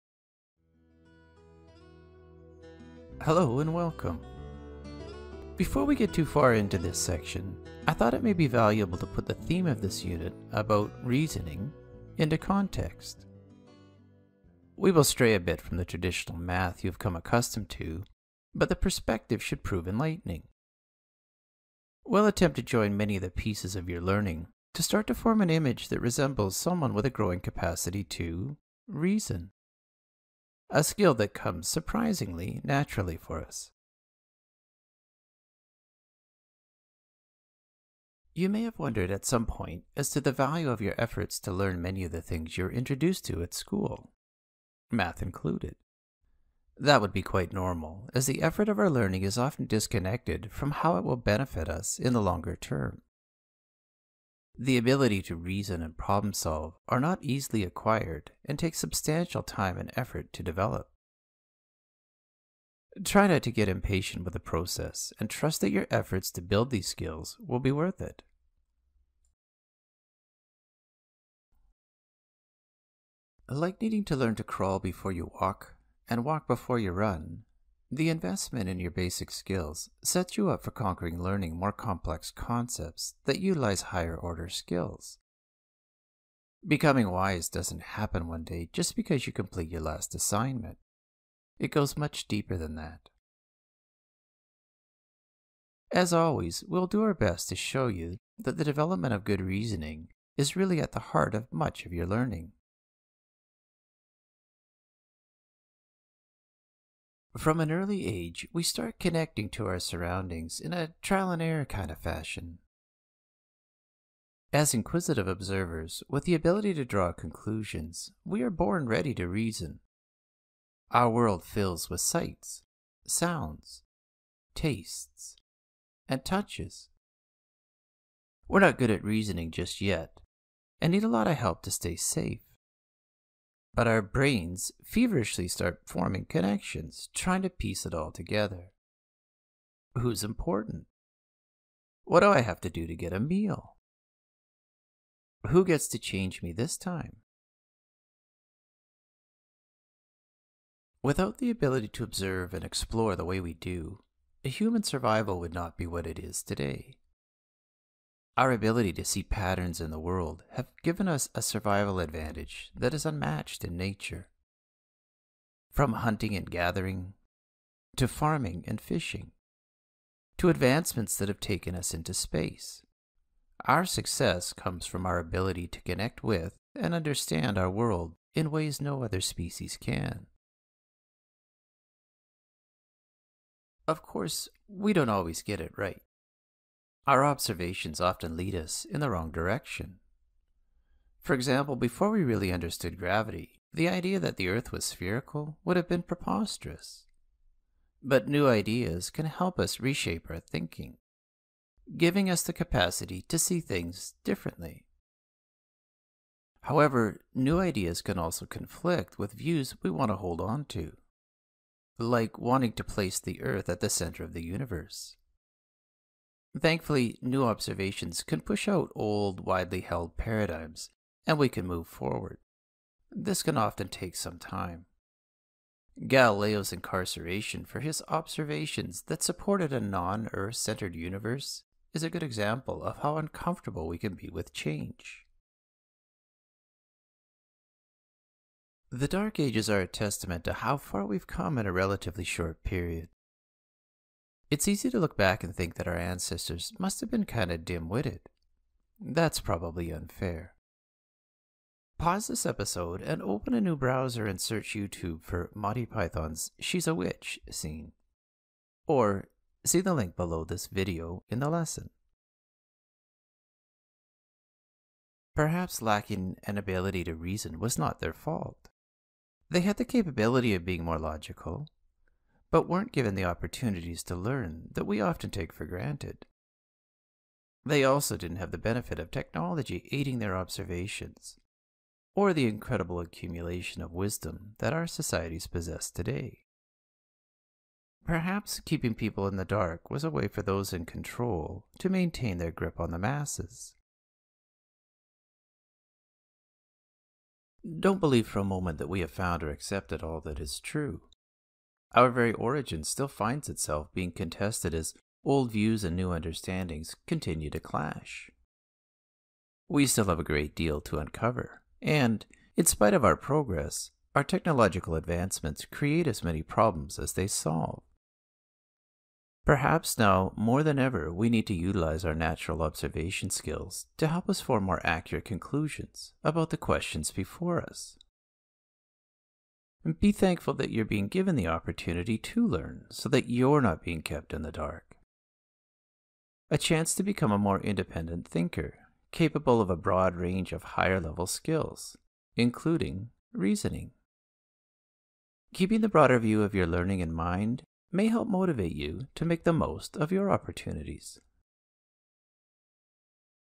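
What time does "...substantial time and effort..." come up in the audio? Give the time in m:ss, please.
0:58.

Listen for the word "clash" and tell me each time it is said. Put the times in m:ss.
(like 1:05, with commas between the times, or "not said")
5:07.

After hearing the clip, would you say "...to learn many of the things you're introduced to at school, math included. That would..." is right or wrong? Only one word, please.
right.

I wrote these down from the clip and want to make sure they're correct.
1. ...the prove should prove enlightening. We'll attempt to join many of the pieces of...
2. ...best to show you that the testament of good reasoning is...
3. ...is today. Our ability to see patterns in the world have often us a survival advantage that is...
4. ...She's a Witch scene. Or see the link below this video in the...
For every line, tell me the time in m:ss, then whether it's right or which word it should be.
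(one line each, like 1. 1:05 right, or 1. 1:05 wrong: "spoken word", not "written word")
1. 0:18 wrong: "perspective", not "prove"
2. 1:37 wrong: "development", not "testament"
3. 2:36 wrong: "given", not "often"
4. 4:16 right.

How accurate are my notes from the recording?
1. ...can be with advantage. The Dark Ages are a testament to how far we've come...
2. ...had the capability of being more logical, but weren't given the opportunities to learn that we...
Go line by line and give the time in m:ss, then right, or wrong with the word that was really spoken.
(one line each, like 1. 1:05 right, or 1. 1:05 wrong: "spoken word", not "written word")
1. 3:53 wrong: "change", not "advantage"
2. 4:29 right.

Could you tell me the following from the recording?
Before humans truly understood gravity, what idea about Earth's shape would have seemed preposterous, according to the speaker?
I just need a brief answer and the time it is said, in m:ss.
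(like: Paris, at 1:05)
Spherical, at 3:14.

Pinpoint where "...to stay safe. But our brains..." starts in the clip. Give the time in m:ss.
2:11.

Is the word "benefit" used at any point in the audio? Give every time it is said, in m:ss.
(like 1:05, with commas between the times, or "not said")
0:51, 4:38.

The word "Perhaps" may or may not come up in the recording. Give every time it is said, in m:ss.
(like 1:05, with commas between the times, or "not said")
4:25, 4:48, 5:19.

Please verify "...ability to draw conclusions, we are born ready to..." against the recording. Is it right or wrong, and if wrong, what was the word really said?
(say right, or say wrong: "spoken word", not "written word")
right.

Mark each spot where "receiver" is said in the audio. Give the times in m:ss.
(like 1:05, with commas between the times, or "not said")
not said.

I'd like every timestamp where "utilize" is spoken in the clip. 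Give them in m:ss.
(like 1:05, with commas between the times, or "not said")
1:23, 5:21.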